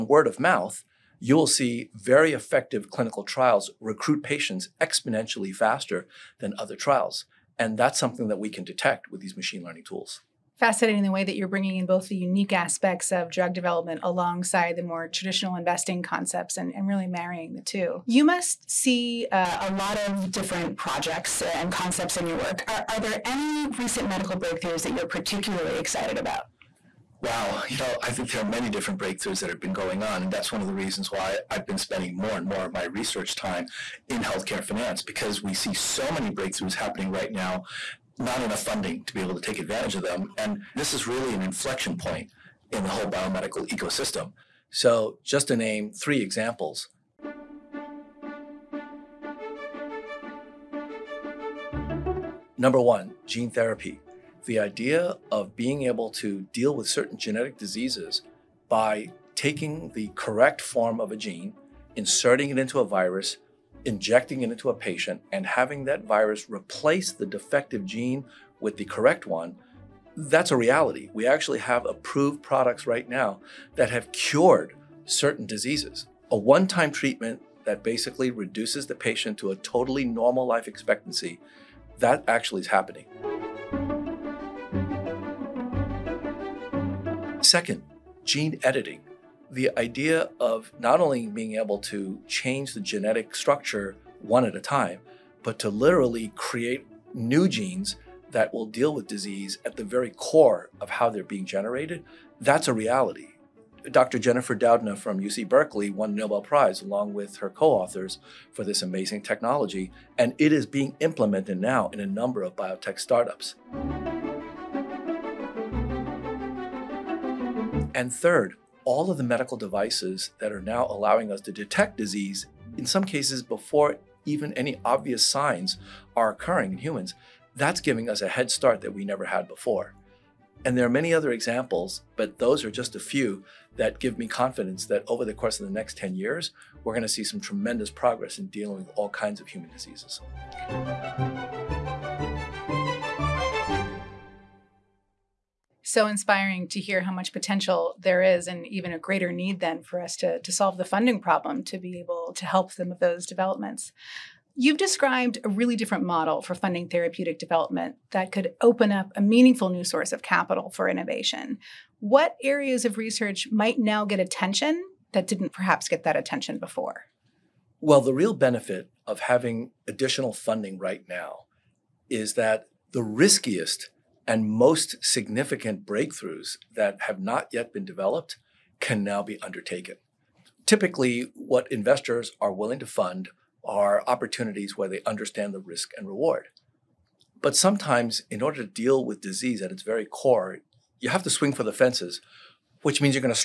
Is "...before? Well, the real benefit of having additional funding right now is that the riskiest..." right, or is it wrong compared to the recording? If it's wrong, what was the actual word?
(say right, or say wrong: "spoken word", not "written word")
right.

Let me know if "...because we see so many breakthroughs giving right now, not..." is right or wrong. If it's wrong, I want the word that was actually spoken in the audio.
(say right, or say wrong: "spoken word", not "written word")
wrong: "happening", not "giving".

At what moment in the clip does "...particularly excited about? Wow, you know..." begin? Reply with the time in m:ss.
0:25.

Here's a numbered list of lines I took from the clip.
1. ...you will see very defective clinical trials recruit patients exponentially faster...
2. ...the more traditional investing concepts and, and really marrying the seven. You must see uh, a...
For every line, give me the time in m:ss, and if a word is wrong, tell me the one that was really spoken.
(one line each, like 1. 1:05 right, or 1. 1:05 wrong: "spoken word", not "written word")
1. 0:01 wrong: "effective", not "defective"
2. 0:14 wrong: "two", not "seven".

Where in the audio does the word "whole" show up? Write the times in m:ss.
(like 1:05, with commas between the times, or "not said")
0:42.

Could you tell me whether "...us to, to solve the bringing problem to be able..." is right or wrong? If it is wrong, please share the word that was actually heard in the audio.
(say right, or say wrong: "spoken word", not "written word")
wrong: "funding", not "bringing".